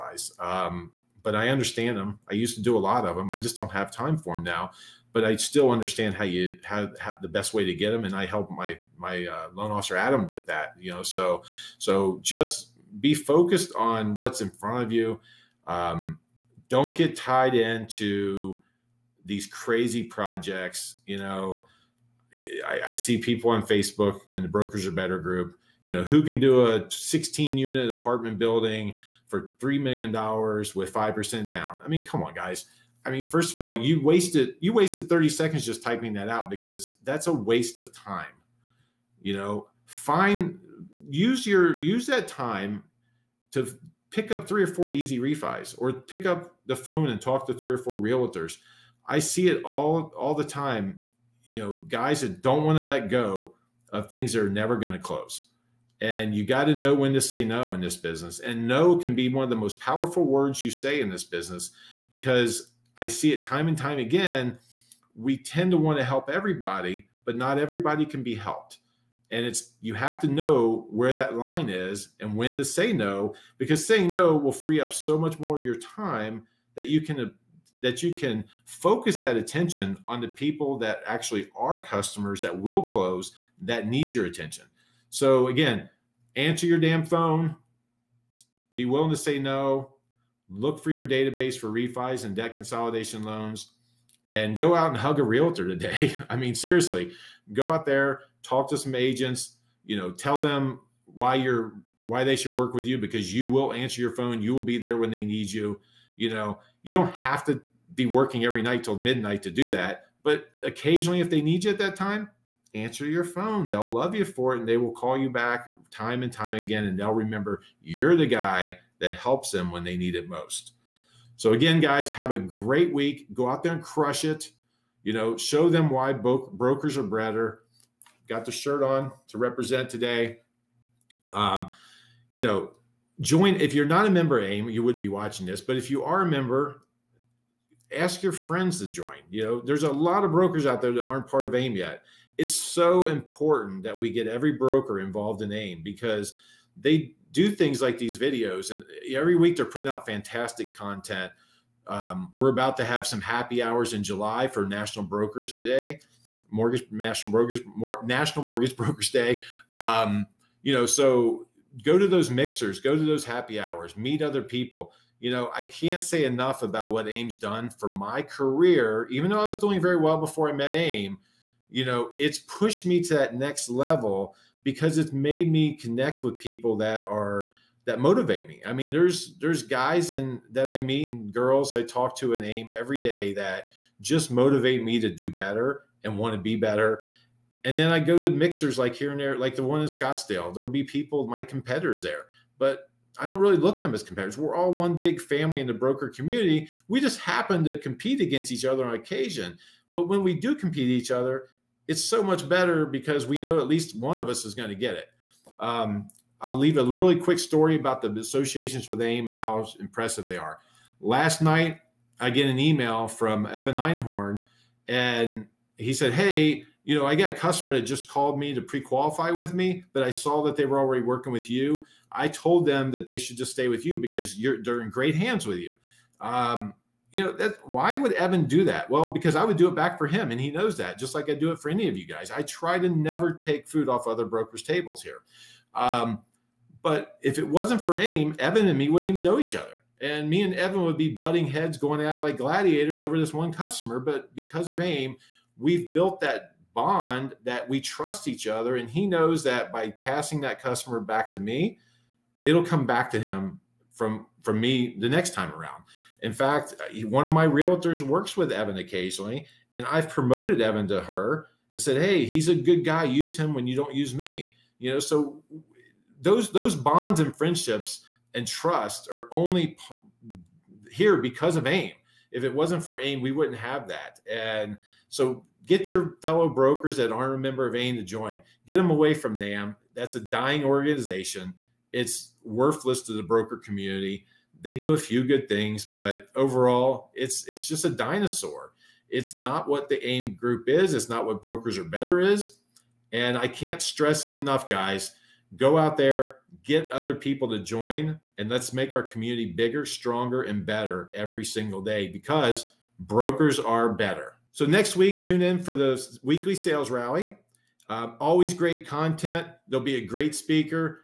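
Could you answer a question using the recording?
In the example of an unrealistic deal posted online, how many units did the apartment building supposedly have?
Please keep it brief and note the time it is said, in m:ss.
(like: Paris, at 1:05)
16, at 0:26.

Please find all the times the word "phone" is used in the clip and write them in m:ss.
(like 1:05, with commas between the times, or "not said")
0:46, 1:27, 1:44, 1:53.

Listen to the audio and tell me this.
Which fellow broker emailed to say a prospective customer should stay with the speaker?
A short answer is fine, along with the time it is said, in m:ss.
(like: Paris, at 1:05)
Evan Einhorn, at 3:33.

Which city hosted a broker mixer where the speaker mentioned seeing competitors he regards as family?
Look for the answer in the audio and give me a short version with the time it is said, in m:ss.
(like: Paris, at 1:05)
Scottsdale, at 3:09.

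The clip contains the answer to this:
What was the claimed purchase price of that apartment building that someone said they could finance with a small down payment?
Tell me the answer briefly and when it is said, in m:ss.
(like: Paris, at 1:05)
$3 million, at 0:29.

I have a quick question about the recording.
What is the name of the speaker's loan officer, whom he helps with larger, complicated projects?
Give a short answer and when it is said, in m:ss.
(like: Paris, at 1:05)
Adam, at 0:09.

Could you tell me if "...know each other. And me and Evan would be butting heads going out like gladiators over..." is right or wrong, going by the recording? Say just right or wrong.
right.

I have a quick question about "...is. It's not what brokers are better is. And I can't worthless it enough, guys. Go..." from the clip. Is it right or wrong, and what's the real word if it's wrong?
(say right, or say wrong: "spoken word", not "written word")
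wrong: "stress", not "worthless".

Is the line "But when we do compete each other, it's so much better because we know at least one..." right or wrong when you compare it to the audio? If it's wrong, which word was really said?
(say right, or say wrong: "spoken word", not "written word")
right.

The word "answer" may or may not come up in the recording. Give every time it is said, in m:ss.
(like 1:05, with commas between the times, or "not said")
1:26, 1:43, 1:52.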